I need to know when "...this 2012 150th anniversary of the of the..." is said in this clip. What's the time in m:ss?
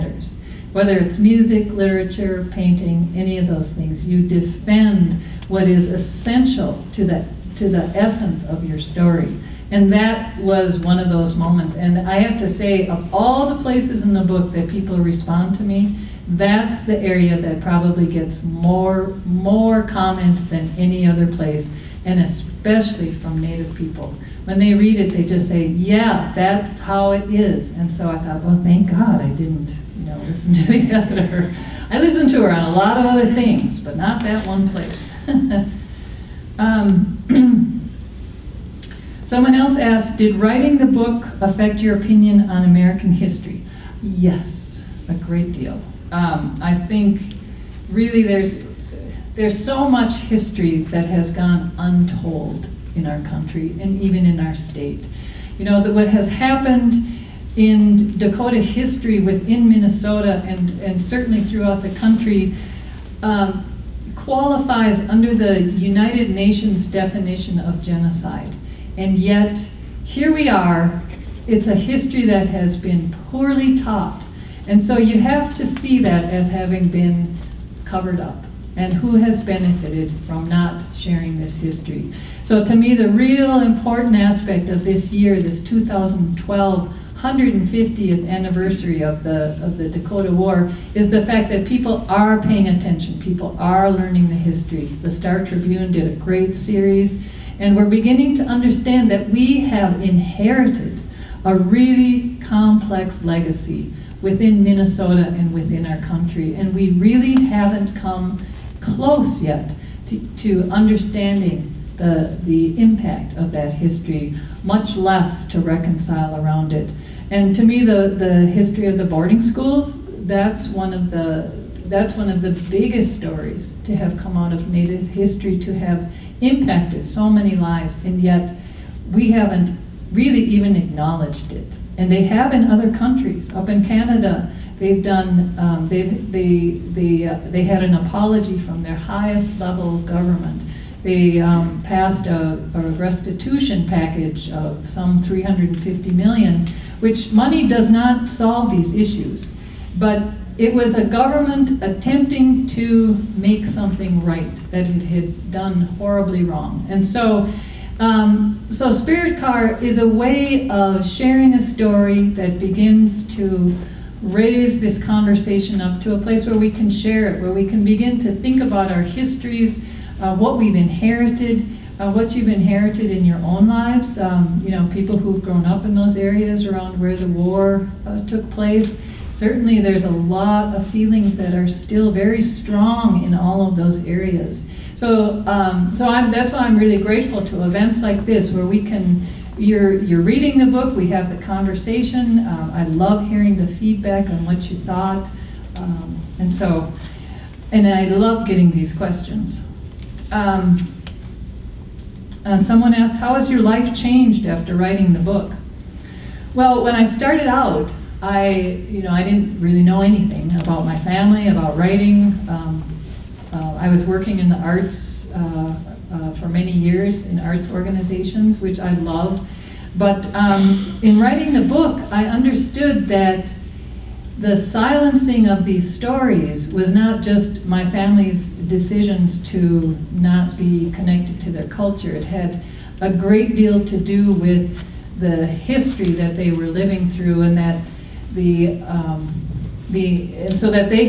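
1:25.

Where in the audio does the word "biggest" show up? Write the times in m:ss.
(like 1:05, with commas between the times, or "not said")
2:02.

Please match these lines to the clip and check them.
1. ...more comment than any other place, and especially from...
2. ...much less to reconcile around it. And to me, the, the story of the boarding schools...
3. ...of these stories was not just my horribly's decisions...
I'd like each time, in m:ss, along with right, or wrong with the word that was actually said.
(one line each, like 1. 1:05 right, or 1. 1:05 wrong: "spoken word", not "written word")
1. 0:19 right
2. 1:54 wrong: "history", not "story"
3. 3:45 wrong: "family", not "horribly".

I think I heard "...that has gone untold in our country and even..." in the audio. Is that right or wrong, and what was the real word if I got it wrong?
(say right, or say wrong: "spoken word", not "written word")
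right.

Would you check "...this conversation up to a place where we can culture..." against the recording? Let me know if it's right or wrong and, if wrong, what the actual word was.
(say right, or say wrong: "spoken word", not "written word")
wrong: "share", not "culture".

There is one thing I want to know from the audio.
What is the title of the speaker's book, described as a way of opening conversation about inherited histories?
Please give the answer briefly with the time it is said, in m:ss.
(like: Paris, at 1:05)
Spirit Car, at 2:38.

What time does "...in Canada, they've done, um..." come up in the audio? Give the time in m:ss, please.
2:13.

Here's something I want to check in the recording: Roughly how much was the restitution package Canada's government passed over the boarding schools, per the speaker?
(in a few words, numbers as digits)
350 million.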